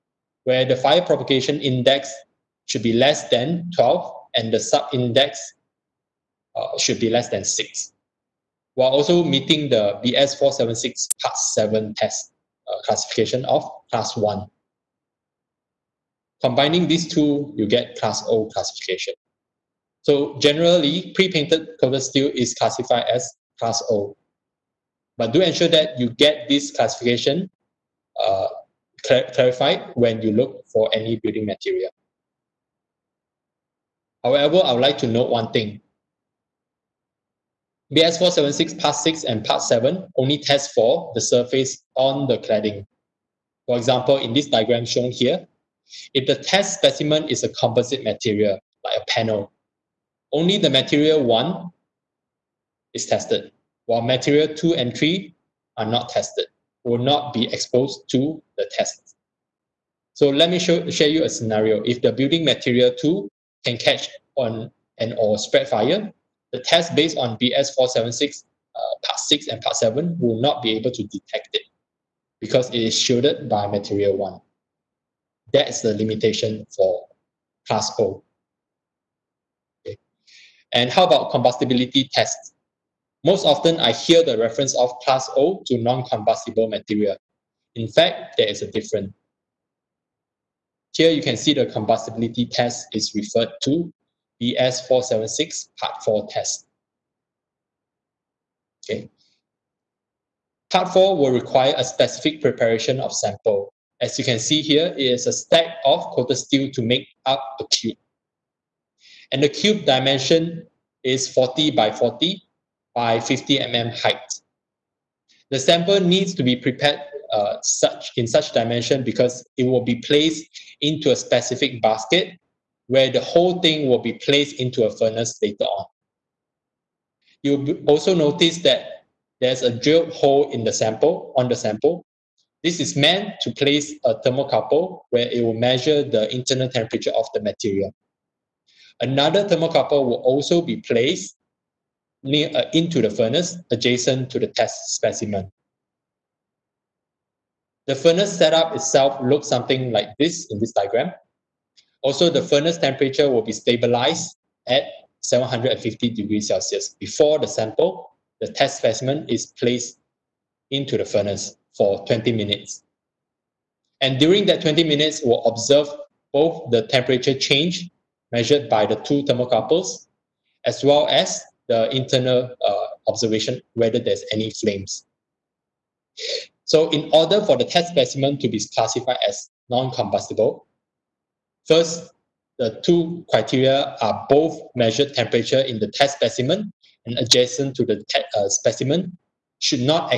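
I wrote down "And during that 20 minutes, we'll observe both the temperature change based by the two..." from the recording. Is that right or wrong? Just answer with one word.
wrong.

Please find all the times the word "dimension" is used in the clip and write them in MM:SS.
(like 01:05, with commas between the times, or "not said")
01:49, 01:58.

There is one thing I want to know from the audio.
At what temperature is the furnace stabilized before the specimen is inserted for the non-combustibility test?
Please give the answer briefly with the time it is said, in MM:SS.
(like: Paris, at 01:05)
750 degrees Celsius, at 02:35.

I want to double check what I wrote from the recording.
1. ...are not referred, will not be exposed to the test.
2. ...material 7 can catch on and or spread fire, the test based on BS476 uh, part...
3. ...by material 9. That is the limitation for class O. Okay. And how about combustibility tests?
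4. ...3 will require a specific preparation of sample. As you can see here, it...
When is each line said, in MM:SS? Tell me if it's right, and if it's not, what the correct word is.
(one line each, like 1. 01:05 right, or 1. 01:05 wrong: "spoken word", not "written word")
1. 00:55 wrong: "tested", not "referred"
2. 01:02 wrong: "2", not "7"
3. 01:13 wrong: "1", not "9"
4. 01:40 wrong: "4", not "3".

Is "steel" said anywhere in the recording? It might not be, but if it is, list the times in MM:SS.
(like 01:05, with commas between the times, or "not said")
00:22, 01:46.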